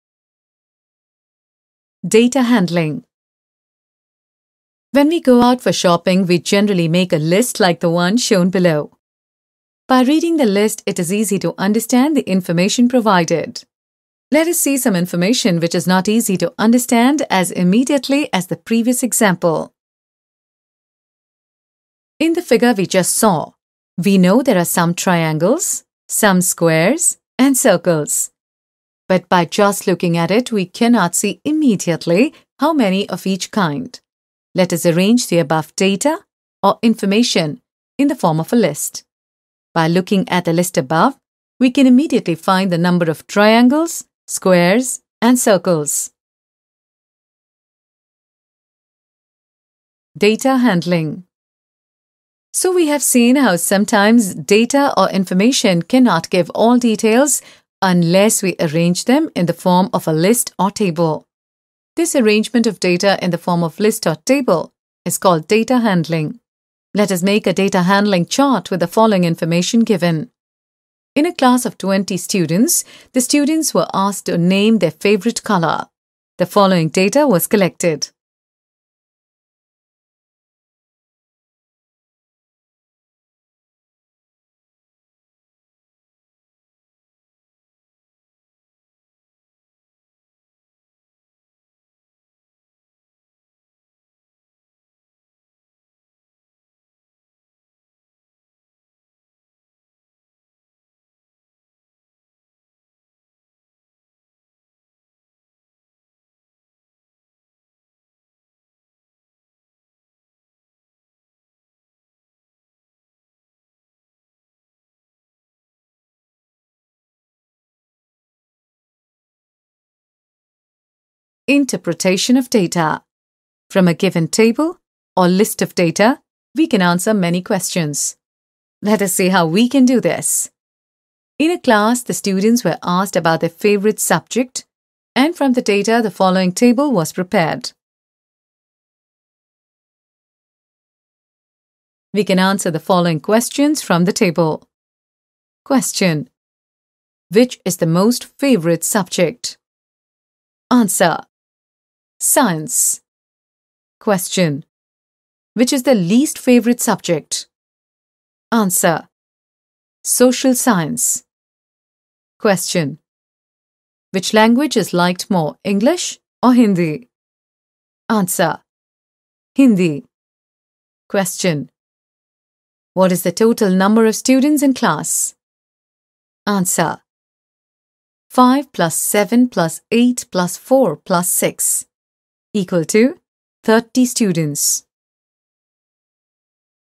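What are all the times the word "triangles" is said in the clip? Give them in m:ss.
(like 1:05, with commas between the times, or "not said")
0:24, 0:43.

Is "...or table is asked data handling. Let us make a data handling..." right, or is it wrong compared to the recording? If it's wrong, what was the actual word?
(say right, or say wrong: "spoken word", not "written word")
wrong: "called", not "asked".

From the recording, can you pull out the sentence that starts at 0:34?
Let us arrange the above data or information in the form of a list.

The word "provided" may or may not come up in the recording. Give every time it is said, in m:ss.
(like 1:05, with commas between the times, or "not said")
0:12.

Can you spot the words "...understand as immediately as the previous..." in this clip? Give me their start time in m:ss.
0:16.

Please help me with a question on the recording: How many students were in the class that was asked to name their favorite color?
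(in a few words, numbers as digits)
20.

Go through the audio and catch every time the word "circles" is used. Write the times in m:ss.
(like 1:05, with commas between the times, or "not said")
0:27, 0:45.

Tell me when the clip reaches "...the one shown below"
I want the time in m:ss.
0:07.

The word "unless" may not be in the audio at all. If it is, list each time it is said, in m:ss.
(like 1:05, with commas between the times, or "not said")
0:57.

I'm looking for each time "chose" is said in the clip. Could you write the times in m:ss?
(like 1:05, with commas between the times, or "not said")
not said.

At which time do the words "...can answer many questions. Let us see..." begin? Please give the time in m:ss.
2:06.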